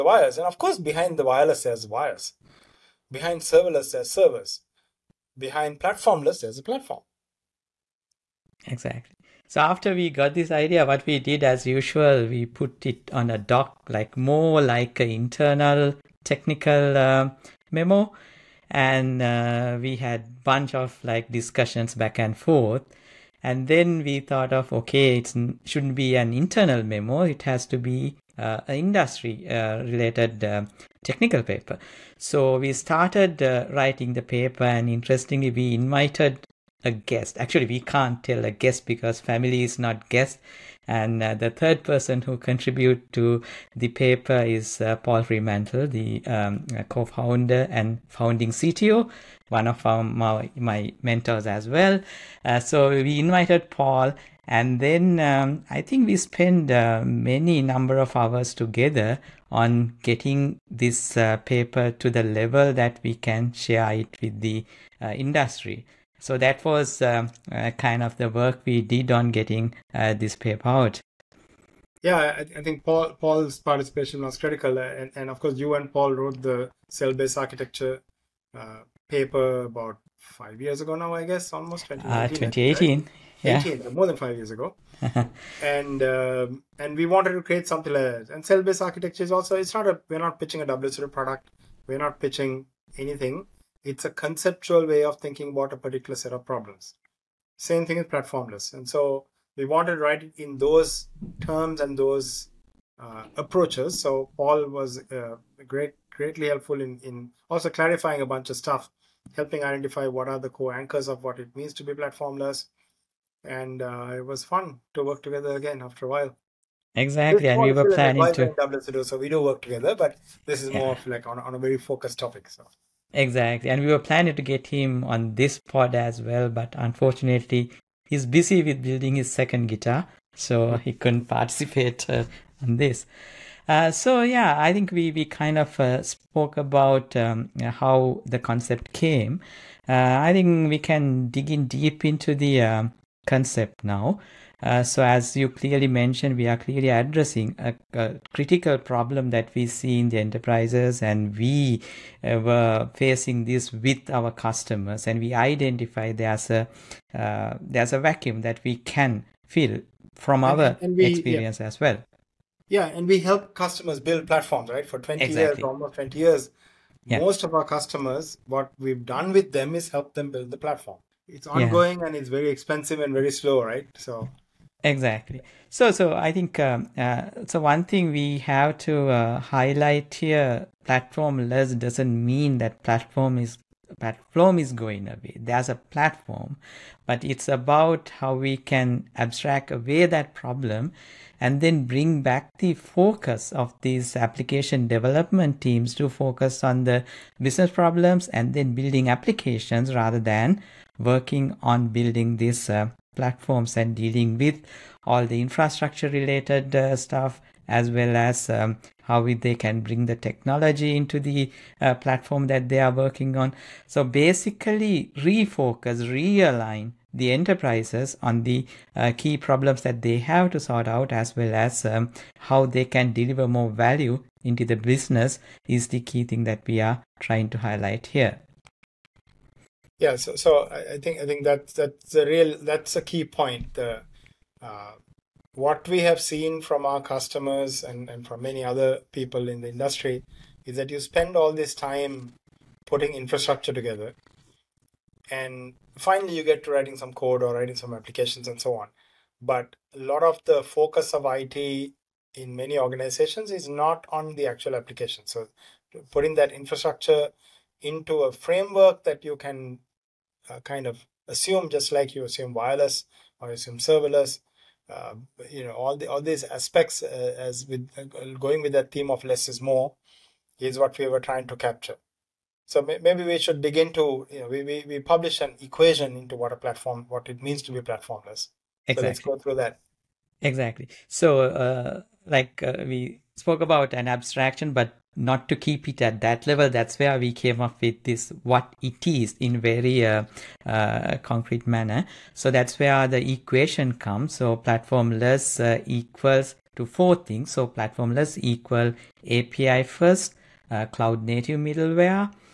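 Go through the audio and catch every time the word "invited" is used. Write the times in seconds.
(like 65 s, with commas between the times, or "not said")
35 s, 53 s.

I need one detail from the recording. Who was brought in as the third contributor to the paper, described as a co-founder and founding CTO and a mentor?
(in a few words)
Paul Fremantle.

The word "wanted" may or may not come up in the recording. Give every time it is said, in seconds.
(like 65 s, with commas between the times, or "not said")
87 s, 99 s.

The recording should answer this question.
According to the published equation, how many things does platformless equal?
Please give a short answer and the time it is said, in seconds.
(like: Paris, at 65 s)
4, at 296 s.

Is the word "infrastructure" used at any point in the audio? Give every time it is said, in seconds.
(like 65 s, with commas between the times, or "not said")
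205 s, 243 s, 256 s.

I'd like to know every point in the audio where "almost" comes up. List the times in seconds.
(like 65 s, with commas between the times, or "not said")
81 s, 165 s.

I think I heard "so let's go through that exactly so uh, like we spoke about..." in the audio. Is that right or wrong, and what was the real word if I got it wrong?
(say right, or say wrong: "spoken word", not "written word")
right.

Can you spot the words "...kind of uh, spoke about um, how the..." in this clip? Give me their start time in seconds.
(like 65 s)
135 s.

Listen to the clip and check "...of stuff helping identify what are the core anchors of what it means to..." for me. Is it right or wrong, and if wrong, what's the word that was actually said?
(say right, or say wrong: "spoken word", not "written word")
right.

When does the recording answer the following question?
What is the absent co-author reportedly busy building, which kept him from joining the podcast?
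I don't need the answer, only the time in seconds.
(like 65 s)
129 s.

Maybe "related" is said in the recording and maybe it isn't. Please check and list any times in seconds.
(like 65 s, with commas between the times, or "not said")
29 s, 206 s.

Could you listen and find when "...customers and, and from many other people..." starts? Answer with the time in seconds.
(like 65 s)
237 s.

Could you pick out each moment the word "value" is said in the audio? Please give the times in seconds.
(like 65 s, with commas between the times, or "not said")
223 s.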